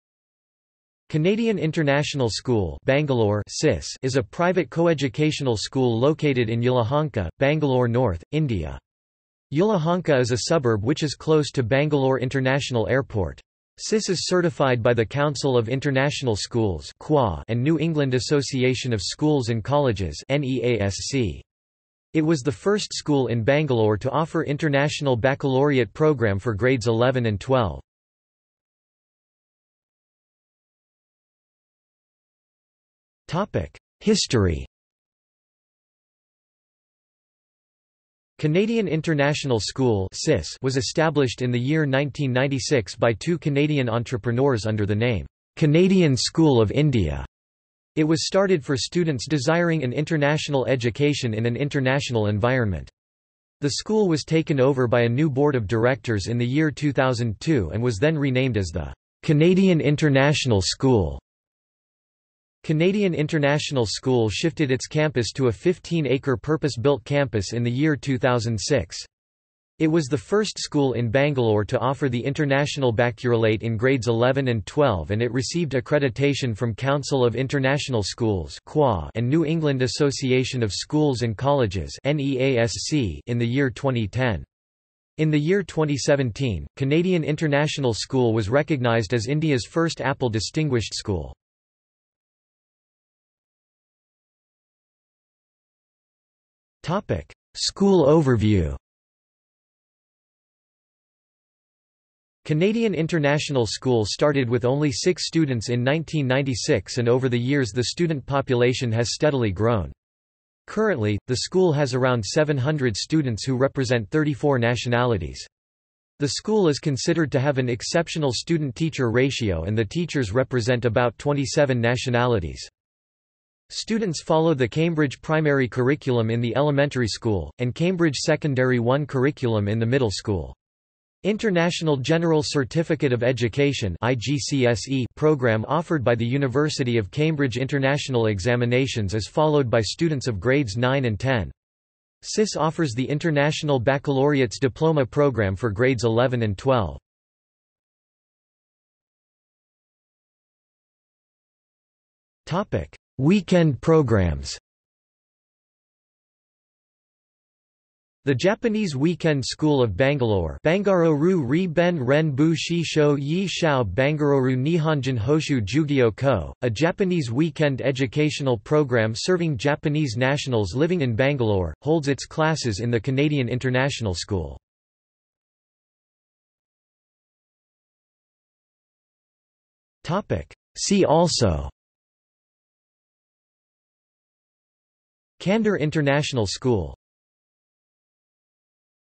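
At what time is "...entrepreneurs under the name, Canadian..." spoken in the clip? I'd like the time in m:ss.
0:43.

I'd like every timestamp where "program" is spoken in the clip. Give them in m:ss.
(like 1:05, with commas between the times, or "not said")
0:25, 2:15, 2:25, 2:33, 2:48.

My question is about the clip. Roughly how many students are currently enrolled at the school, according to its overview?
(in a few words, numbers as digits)
700.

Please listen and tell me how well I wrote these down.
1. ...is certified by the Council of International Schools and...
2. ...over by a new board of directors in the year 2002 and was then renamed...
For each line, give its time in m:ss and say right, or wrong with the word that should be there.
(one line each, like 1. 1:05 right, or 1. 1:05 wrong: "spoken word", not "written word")
1. 0:14 right
2. 0:54 right.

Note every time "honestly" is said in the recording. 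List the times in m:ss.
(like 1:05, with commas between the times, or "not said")
not said.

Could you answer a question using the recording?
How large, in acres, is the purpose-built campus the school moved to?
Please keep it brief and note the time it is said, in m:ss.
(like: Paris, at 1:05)
15-acre, at 1:05.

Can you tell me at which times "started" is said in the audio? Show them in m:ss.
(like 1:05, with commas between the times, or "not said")
0:48, 1:44.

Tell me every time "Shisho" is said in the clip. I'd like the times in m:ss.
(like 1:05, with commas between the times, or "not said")
2:42.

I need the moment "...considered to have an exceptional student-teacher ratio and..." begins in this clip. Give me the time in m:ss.
1:56.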